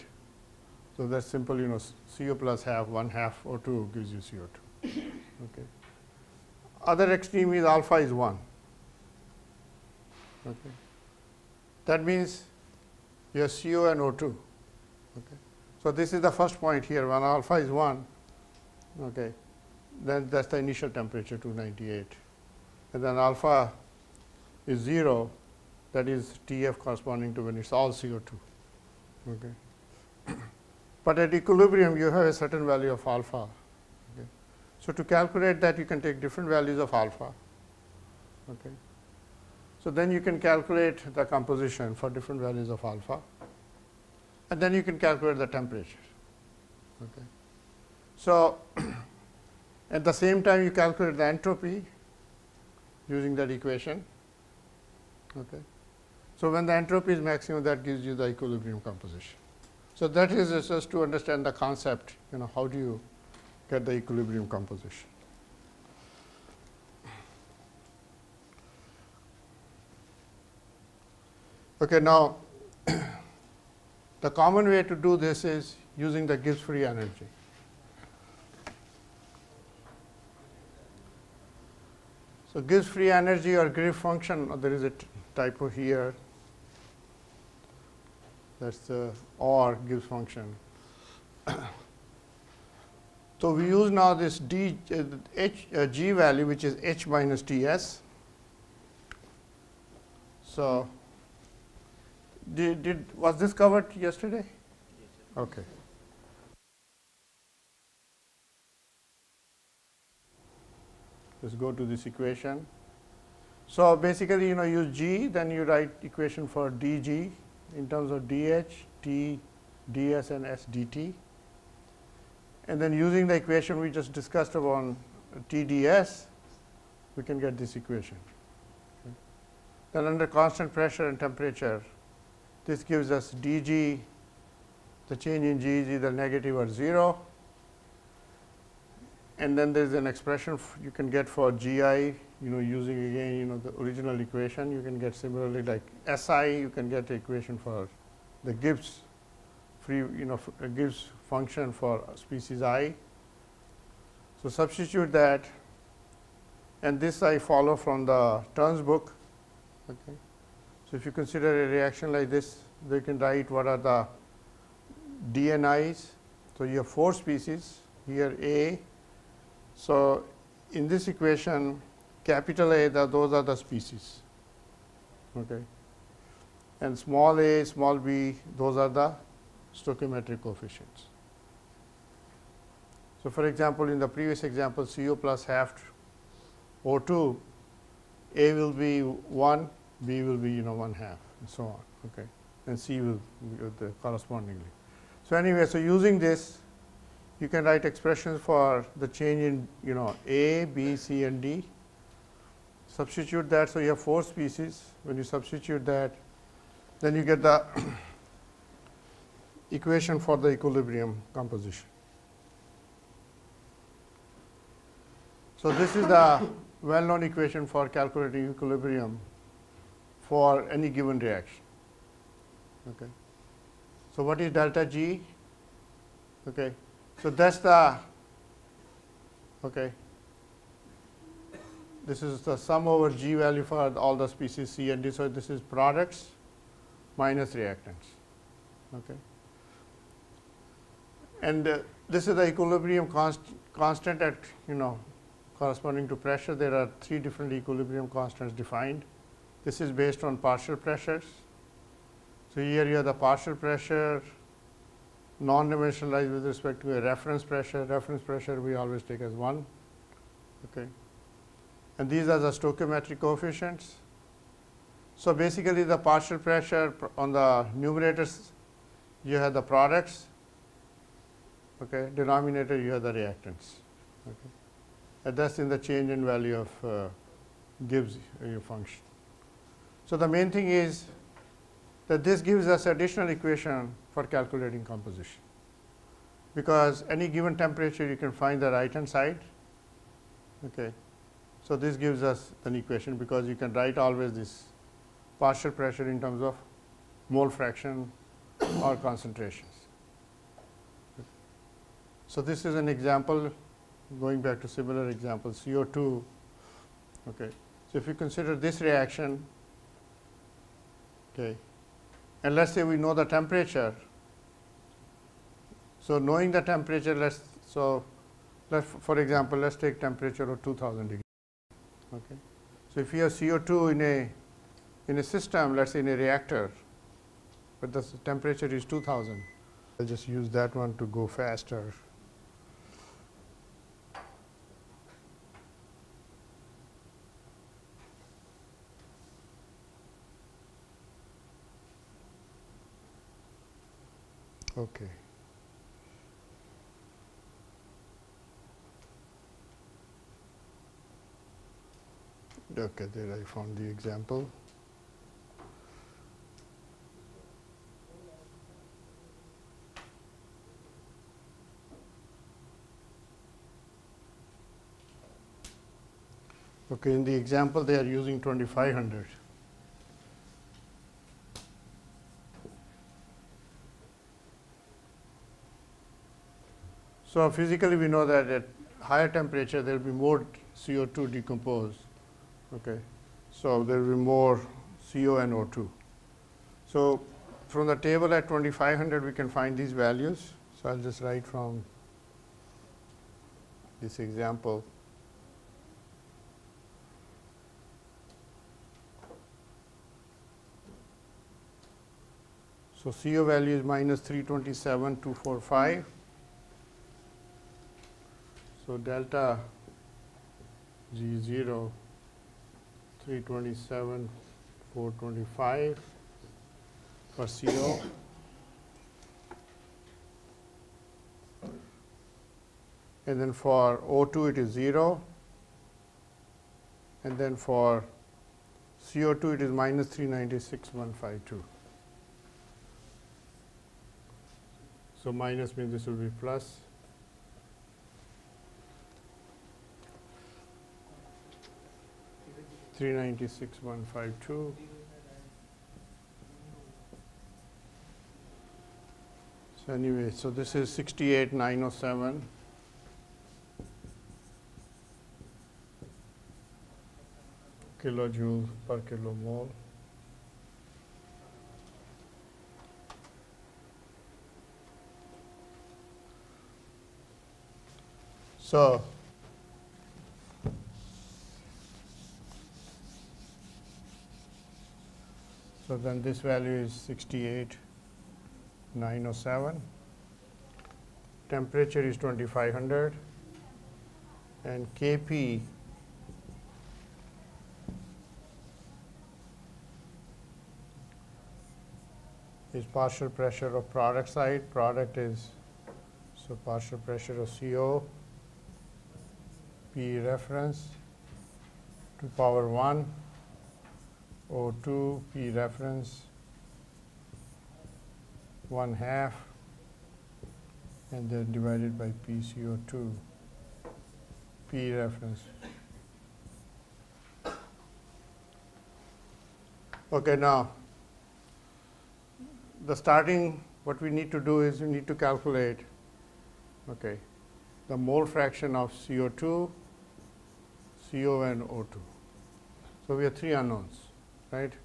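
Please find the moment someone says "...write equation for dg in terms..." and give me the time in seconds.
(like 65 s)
115 s.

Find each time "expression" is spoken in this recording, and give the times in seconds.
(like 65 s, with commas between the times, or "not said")
140 s, 197 s.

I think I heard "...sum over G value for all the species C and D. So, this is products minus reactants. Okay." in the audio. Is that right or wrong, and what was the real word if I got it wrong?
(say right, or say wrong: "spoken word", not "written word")
right.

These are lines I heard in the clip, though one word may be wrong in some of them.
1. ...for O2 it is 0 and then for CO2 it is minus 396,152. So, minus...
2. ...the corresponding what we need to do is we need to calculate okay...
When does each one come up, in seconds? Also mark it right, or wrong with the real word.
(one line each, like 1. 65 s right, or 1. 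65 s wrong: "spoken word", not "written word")
1. 423 s right
2. 522 s wrong: "starting", not "corresponding".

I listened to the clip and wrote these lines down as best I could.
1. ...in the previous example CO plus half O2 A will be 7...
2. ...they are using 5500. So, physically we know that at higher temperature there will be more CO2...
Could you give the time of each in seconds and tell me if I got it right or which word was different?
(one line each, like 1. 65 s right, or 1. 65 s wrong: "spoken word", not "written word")
1. 183 s wrong: "1", not "7"
2. 367 s wrong: "2500", not "5500".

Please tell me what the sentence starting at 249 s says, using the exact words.
This is based on partial pressures.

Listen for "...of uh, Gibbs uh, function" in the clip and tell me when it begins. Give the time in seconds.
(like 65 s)
276 s.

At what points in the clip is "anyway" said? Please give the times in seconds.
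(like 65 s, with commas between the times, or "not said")
195 s, 449 s.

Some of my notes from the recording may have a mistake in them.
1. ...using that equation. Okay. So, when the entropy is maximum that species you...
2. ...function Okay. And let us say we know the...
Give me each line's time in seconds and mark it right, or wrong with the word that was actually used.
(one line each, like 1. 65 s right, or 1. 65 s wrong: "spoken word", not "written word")
1. 53 s wrong: "gives", not "species"
2. 308 s wrong: "reaction", not "function".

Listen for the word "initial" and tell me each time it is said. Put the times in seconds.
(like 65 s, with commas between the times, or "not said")
20 s.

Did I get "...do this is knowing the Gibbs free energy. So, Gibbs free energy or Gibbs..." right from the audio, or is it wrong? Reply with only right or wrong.
wrong.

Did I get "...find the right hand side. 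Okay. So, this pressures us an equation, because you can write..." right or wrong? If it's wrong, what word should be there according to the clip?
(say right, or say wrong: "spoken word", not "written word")
wrong: "gives", not "pressures".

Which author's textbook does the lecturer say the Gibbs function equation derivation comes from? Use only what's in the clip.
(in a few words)
Turns.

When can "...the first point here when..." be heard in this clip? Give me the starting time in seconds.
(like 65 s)
16 s.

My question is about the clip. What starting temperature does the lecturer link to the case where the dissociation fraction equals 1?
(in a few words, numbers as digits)
298.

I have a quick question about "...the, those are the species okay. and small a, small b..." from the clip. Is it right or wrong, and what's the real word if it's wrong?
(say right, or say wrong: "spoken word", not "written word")
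right.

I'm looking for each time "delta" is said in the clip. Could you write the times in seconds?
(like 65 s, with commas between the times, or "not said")
224 s, 408 s.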